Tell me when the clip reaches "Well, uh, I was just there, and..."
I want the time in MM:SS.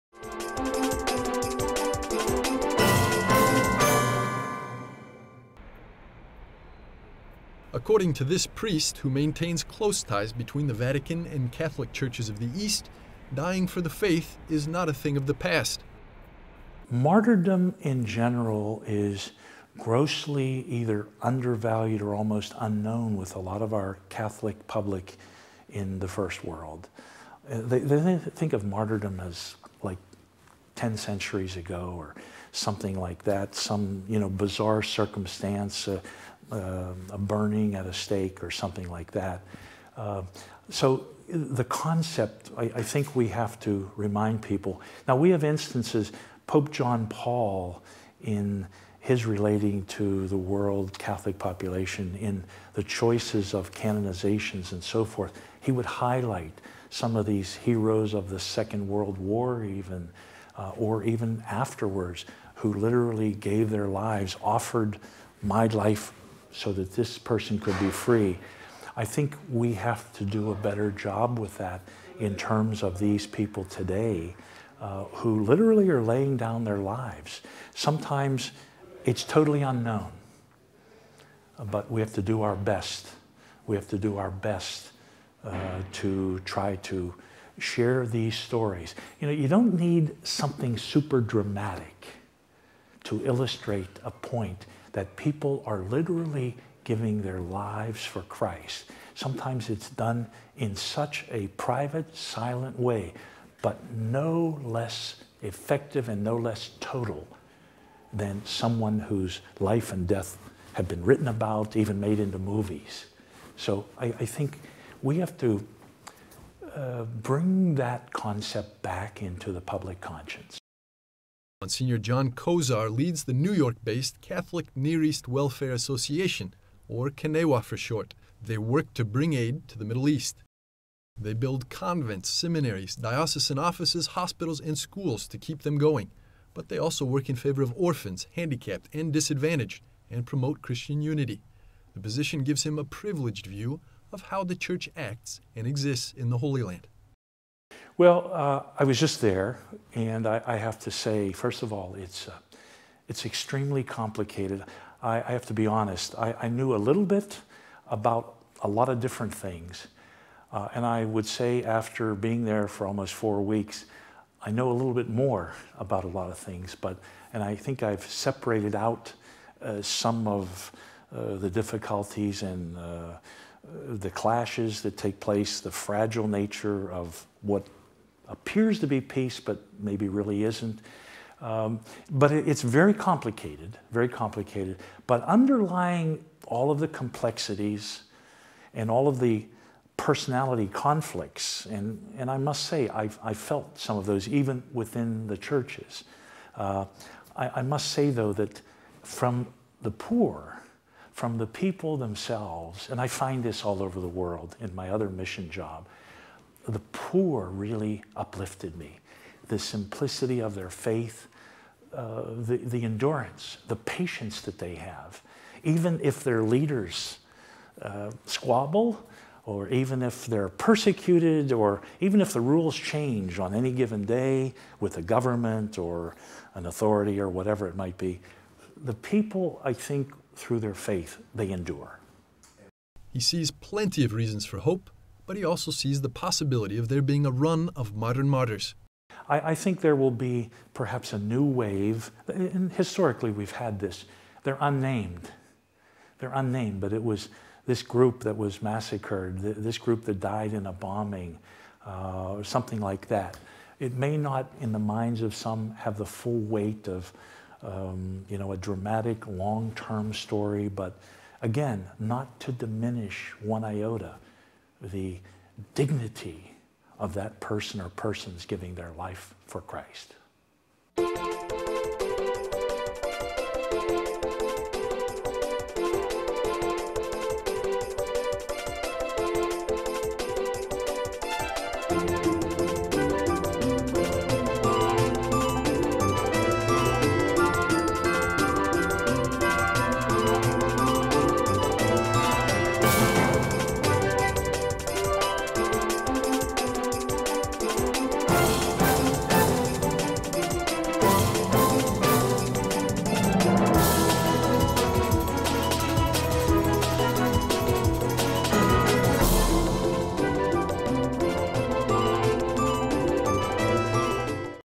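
02:28.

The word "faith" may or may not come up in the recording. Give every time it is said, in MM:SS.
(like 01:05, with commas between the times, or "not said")
00:13, 03:30, 03:50.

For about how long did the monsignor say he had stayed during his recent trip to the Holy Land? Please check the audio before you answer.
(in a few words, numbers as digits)
almost four weeks.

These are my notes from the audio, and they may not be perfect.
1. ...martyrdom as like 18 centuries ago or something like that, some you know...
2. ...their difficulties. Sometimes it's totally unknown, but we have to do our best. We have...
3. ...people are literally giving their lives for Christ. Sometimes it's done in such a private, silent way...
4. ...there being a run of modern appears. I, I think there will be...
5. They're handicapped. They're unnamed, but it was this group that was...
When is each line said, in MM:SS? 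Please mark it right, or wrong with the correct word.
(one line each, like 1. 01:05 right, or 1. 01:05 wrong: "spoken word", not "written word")
1. 00:28 wrong: "10", not "18"
2. 01:16 wrong: "lives", not "difficulties"
3. 01:35 right
4. 03:56 wrong: "martyrs", not "appears"
5. 04:04 wrong: "unnamed", not "handicapped".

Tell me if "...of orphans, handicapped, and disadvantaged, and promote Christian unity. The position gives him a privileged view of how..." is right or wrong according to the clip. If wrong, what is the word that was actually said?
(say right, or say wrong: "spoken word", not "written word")
right.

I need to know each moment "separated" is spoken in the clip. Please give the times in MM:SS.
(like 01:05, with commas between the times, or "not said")
02:48.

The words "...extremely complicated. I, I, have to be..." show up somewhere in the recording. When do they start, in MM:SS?
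02:33.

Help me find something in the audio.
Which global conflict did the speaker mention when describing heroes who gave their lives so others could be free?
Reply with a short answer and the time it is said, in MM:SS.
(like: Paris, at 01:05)
Second World War, at 00:58.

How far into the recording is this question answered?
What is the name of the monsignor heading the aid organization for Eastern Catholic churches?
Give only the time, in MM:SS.
02:01.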